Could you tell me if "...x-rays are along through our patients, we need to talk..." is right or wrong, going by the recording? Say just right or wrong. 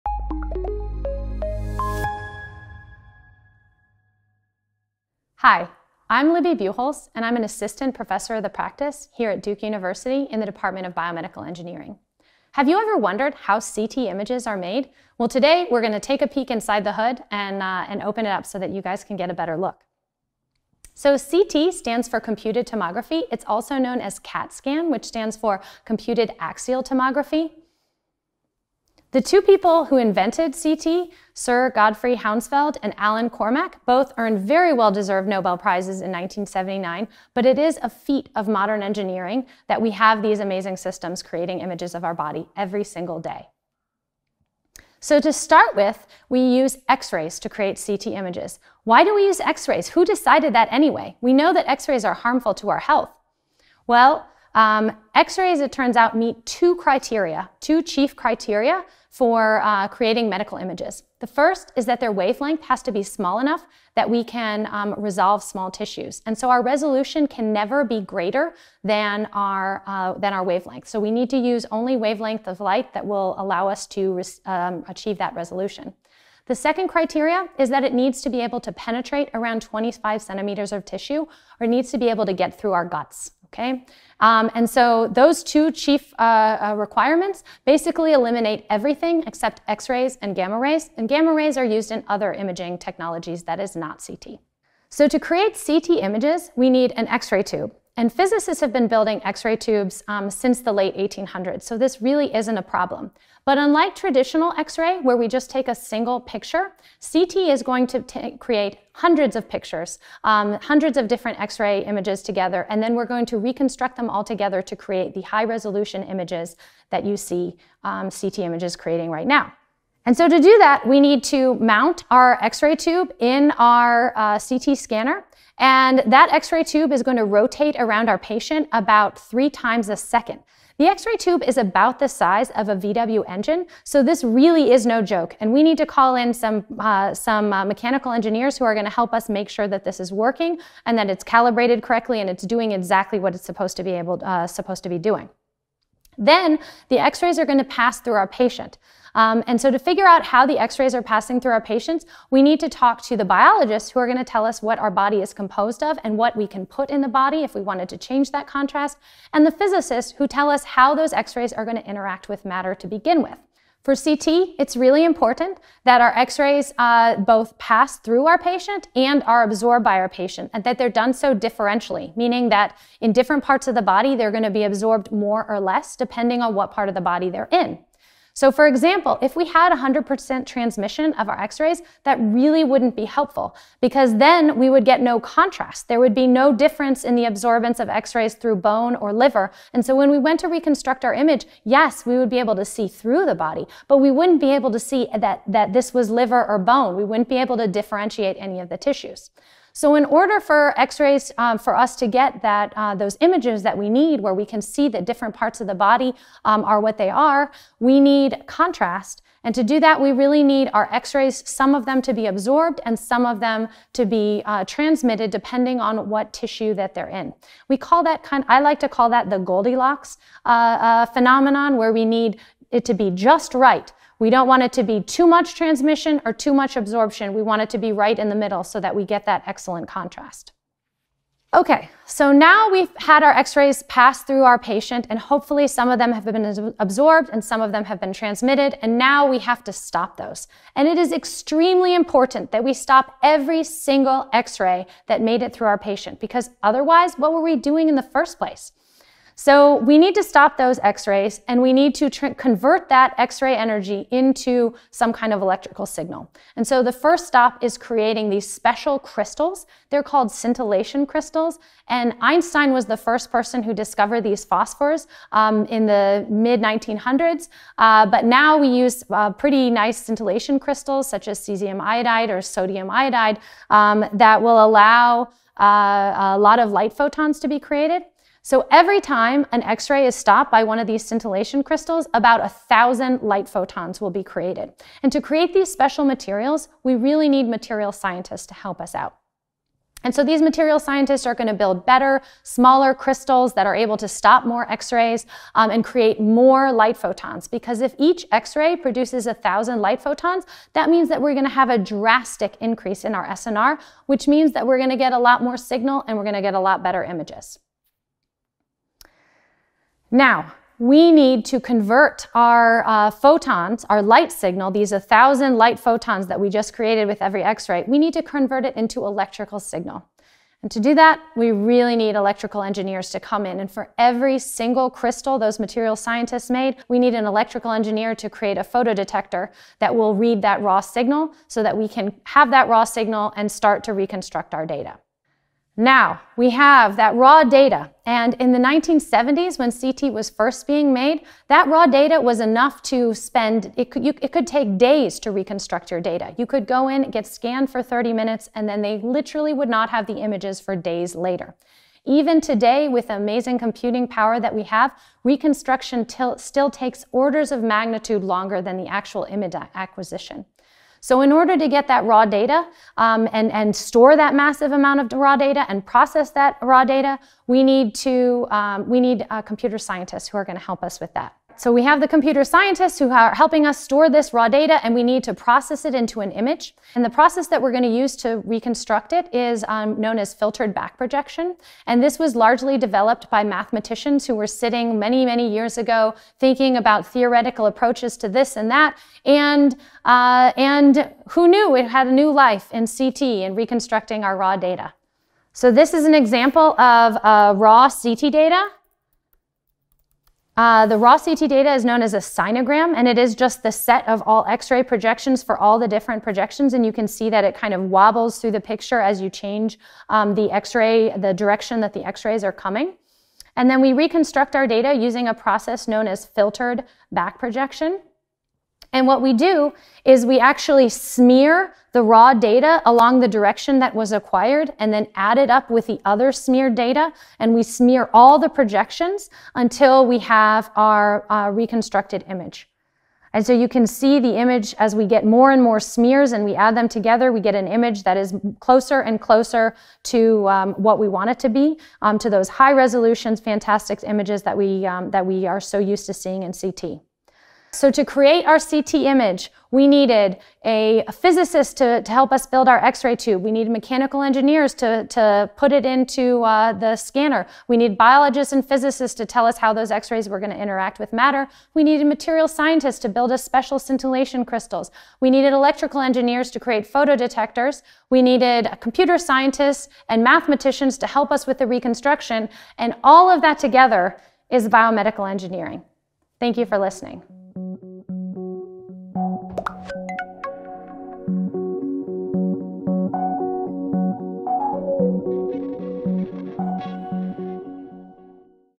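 wrong.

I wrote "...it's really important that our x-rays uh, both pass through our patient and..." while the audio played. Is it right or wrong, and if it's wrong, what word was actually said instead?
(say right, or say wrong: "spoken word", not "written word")
right.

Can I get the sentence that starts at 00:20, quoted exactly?
So CT stands for computed tomography.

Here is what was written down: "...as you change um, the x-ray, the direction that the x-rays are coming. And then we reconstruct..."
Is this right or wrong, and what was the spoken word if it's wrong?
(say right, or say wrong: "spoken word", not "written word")
right.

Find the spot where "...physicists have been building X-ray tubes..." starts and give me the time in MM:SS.
01:38.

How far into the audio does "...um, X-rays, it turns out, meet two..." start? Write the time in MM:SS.
00:54.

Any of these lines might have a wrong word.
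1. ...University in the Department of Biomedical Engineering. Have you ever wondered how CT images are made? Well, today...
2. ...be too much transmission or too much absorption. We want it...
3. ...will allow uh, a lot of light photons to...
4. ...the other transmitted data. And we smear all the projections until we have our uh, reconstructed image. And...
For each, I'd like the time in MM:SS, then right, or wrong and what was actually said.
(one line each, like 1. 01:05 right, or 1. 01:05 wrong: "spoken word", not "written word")
1. 00:09 right
2. 03:44 right
3. 04:34 right
4. 07:05 wrong: "smeared", not "transmitted".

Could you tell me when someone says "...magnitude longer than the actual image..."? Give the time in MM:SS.
05:57.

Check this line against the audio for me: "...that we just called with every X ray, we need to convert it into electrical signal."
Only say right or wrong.
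wrong.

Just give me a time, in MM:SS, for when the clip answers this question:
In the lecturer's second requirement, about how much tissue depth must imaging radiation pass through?
01:19.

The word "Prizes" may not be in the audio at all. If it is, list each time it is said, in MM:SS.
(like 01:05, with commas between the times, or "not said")
00:35.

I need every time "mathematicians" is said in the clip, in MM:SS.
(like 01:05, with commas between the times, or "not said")
06:23, 07:50.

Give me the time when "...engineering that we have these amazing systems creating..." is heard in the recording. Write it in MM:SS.
00:38.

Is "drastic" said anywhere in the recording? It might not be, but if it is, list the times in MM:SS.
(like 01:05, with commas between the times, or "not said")
05:01.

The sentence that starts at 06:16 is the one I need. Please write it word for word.
And the process that we're going to use to reconstruct it is um, known as filtered back projection.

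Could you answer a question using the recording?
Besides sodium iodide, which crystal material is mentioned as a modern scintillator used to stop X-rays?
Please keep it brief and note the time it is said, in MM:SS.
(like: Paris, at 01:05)
cesium iodide, at 04:31.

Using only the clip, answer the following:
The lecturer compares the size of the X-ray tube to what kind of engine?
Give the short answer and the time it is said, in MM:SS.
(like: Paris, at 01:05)
VW engine, at 02:12.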